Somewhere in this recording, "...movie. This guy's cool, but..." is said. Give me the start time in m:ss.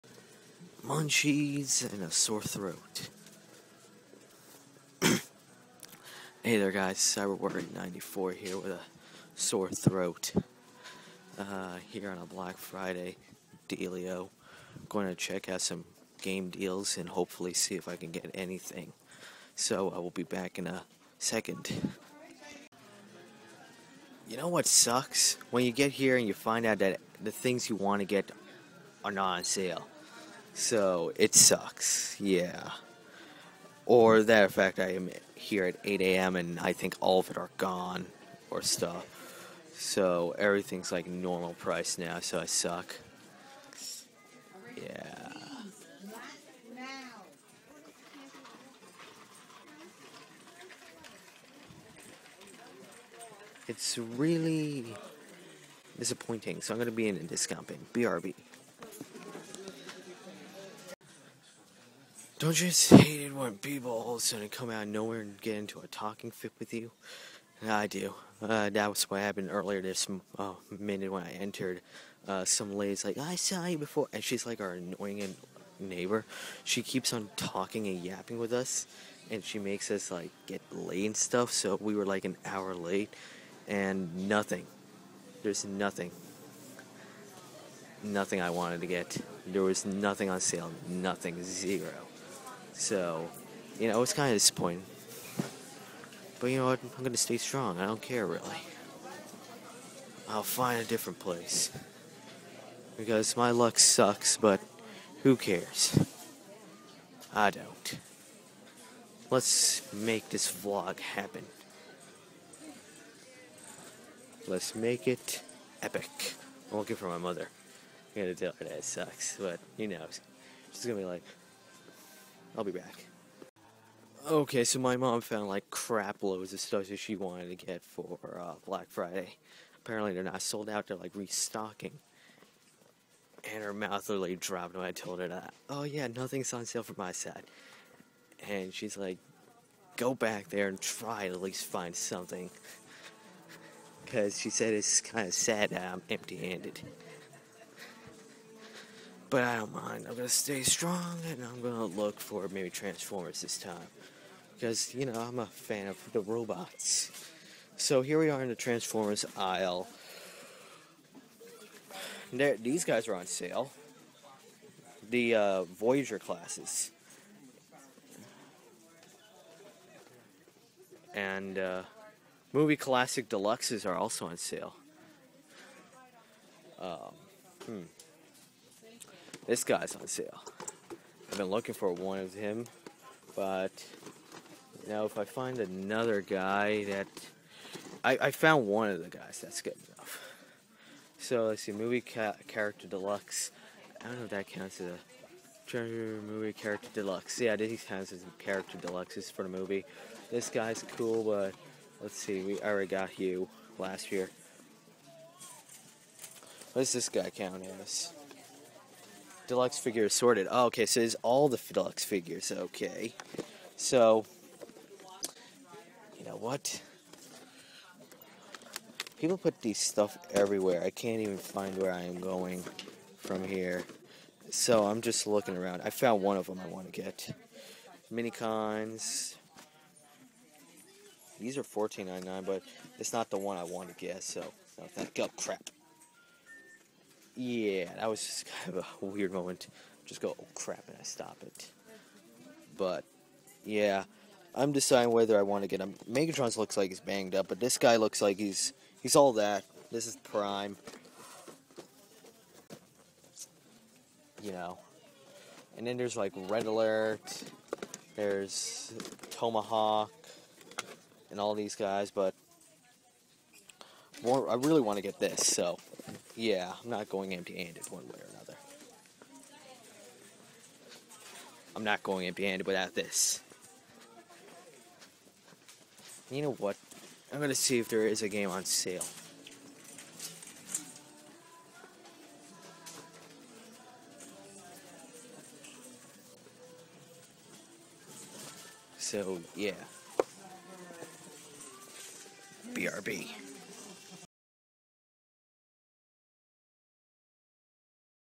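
3:19.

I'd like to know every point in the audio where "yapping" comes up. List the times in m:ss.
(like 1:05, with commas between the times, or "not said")
1:18.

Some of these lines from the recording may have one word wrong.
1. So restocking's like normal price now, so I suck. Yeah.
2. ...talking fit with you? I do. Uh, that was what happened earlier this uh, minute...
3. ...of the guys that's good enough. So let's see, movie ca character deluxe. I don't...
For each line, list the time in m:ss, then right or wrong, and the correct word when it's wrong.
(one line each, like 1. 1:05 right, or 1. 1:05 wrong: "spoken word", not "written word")
1. 0:39 wrong: "everything", not "restocking"
2. 1:05 right
3. 3:08 right.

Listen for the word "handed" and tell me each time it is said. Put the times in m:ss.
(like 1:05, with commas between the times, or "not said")
2:26, 4:27, 4:32.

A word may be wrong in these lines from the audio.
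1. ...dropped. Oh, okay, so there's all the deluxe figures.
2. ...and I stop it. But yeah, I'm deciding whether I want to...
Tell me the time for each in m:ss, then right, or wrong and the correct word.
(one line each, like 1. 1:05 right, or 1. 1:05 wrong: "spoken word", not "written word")
1. 3:30 wrong: "sorted", not "dropped"
2. 4:00 right.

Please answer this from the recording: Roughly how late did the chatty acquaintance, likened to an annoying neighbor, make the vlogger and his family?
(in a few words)
an hour.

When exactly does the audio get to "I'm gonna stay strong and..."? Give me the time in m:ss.
2:30.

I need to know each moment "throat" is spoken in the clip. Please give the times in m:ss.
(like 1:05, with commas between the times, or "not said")
0:02, 0:09.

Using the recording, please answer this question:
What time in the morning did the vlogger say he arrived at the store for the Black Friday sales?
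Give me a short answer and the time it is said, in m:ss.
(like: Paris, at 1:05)
8 a.m., at 0:35.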